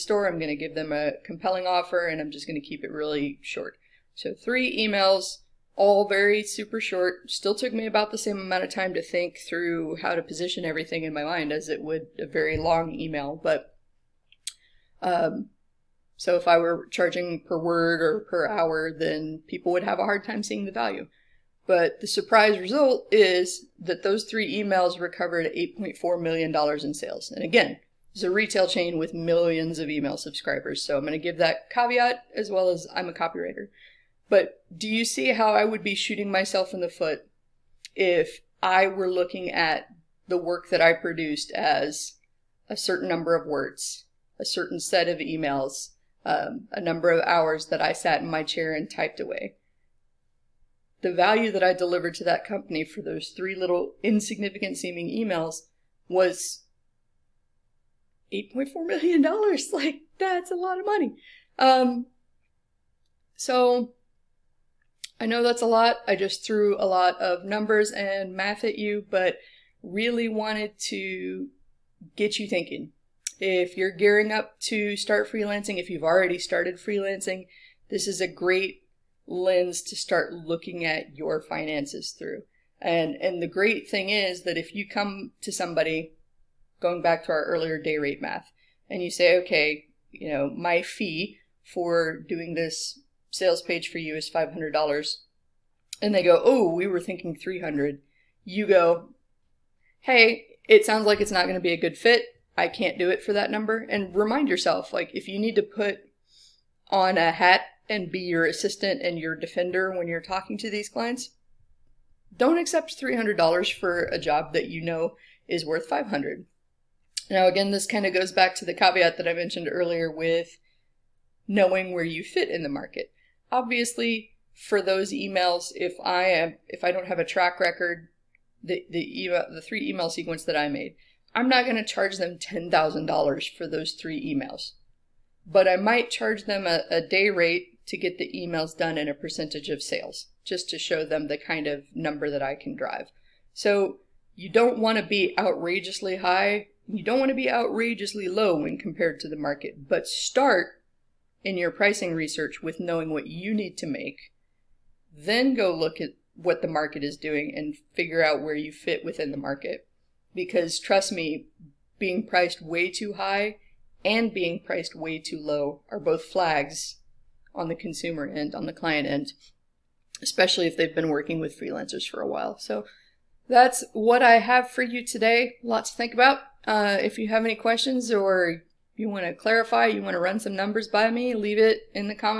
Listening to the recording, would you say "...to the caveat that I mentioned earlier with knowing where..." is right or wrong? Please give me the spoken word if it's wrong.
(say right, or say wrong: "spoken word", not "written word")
right.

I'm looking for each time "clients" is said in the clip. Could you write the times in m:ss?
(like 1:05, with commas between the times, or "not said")
1:50, 2:48.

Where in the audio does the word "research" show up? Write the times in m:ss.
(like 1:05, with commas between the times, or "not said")
2:32.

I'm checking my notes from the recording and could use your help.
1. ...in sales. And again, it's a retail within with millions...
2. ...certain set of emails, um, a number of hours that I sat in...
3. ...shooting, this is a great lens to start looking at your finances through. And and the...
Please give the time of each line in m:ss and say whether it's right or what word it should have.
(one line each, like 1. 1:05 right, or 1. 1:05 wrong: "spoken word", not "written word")
1. 0:26 wrong: "chain", not "within"
2. 0:44 right
3. 1:16 wrong: "freelancing", not "shooting".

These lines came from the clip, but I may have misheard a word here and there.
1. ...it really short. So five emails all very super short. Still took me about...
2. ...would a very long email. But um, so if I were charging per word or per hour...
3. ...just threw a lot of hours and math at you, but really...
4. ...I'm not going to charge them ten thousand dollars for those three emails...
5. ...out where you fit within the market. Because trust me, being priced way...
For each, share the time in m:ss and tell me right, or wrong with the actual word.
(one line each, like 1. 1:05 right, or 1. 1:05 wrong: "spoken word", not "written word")
1. 0:02 wrong: "three", not "five"
2. 0:11 right
3. 1:06 wrong: "numbers", not "hours"
4. 2:11 right
5. 2:38 right.